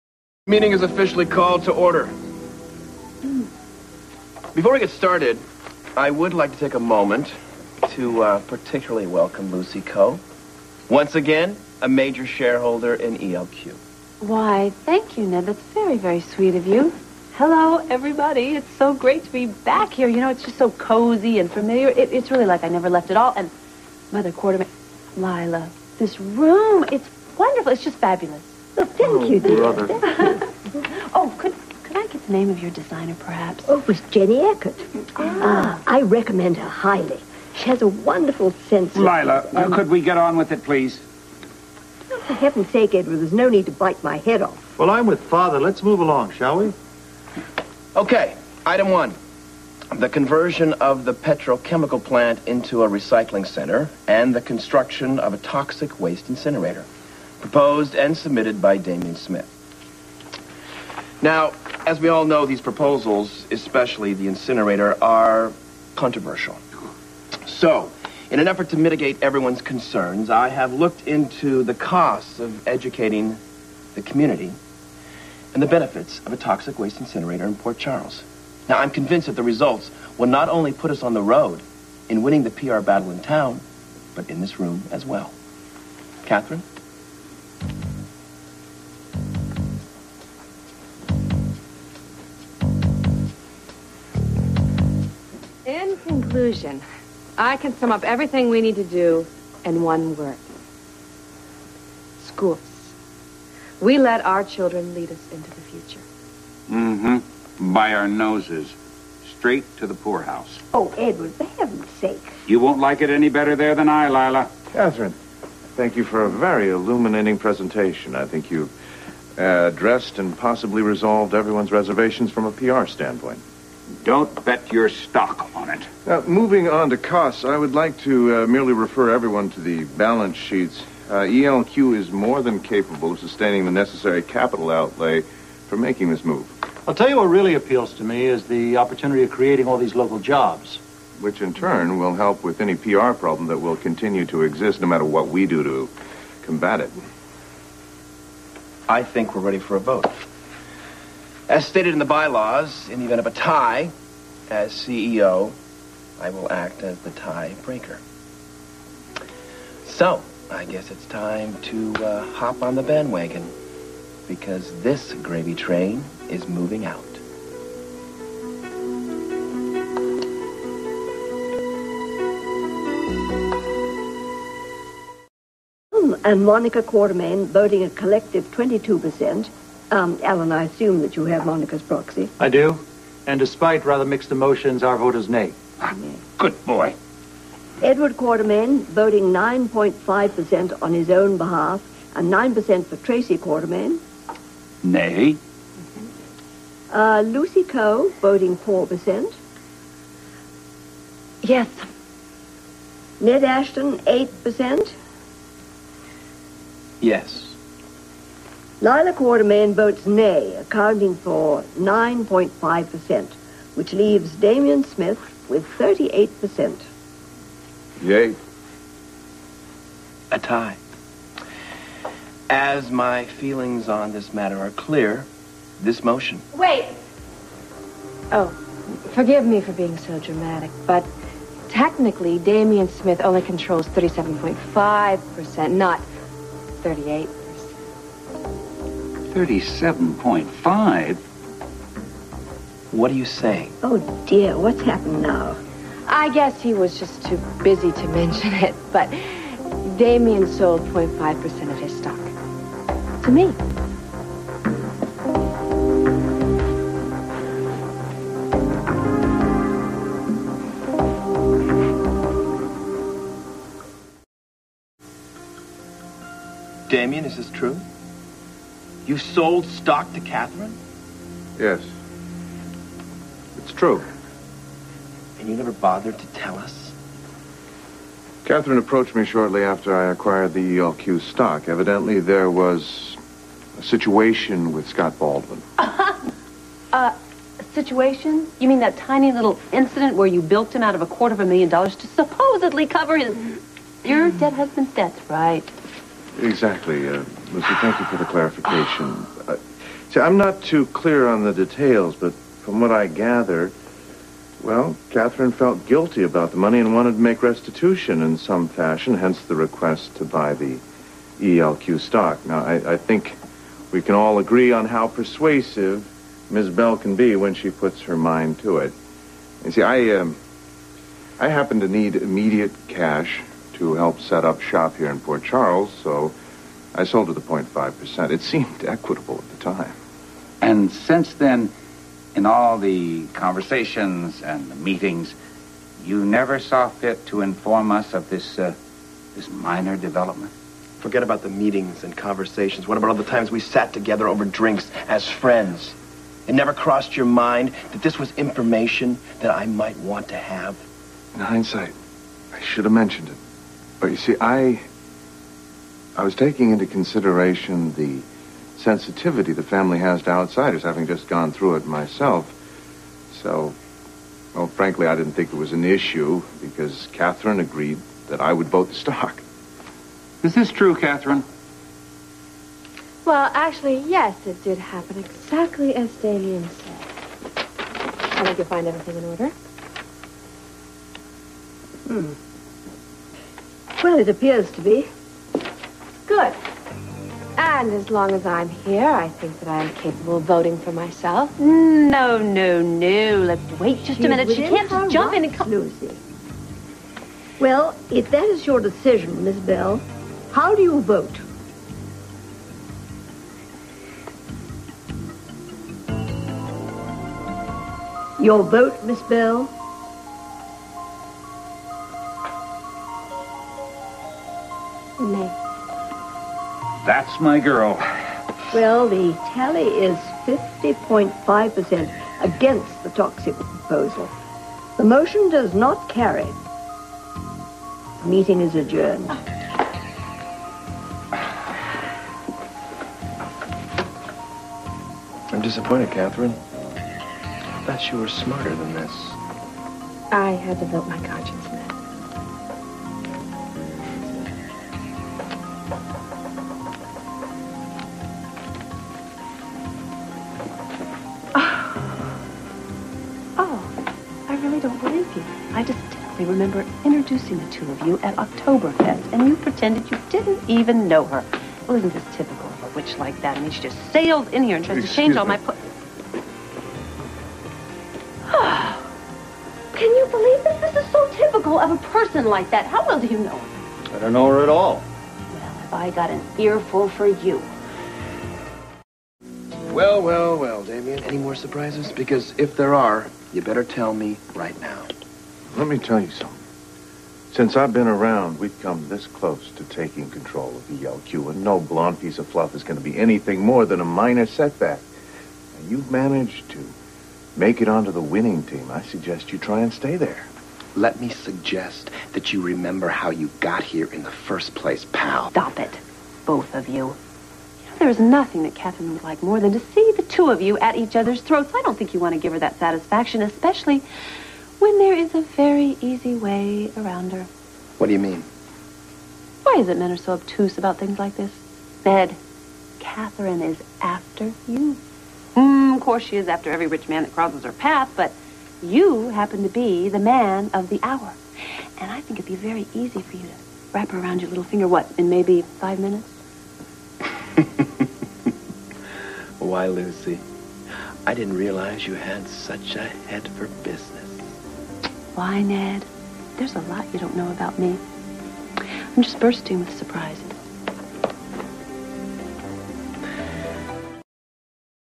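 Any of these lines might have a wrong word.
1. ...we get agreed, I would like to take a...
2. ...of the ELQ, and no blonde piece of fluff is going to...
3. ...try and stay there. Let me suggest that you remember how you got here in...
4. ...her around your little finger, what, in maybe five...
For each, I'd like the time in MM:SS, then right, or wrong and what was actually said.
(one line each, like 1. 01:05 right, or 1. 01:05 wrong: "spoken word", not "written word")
1. 00:04 wrong: "started", not "agreed"
2. 08:10 right
3. 08:19 right
4. 08:54 right.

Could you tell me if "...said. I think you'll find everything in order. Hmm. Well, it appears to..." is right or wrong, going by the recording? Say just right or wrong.
right.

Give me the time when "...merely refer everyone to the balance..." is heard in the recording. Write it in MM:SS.
02:08.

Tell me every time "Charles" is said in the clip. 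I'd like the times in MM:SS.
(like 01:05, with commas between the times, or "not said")
01:17, 05:25.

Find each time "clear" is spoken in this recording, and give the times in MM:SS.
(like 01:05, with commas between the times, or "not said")
03:44, 05:00.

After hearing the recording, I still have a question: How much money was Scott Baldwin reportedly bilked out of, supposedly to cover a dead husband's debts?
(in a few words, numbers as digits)
A quarter of a million dollars.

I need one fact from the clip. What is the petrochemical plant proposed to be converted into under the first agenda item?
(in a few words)
A recycling center.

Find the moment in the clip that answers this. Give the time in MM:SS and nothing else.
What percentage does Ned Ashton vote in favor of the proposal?
03:23.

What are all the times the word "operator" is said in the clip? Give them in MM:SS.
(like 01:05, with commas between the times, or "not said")
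not said.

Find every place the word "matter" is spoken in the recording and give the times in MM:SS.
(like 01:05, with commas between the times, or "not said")
02:24, 03:44.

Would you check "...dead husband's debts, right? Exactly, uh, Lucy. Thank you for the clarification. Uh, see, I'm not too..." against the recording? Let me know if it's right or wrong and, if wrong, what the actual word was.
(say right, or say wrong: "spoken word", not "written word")
right.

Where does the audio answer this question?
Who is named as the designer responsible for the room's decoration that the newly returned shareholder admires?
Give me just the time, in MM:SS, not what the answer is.
00:34.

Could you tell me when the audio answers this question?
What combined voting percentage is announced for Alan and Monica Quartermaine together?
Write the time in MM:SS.
02:58.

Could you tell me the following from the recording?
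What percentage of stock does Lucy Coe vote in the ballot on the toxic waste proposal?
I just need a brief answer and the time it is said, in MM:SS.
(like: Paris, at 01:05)
4%, at 03:18.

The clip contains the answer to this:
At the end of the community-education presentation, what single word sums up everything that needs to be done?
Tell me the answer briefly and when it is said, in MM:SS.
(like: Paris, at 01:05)
Schools, at 01:42.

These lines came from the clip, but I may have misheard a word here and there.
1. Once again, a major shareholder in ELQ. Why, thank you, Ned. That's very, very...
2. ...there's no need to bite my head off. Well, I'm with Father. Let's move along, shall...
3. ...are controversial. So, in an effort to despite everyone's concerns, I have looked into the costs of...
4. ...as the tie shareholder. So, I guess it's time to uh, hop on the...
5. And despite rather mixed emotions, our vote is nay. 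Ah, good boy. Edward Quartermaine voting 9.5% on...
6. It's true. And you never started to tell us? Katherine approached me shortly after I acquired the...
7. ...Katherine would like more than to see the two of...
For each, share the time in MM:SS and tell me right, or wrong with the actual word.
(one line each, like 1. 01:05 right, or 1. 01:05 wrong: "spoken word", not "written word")
1. 00:10 right
2. 00:43 right
3. 01:05 wrong: "mitigate", not "despite"
4. 02:36 wrong: "breaker", not "shareholder"
5. 03:03 right
6. 04:33 wrong: "bothered", not "started"
7. 08:28 right.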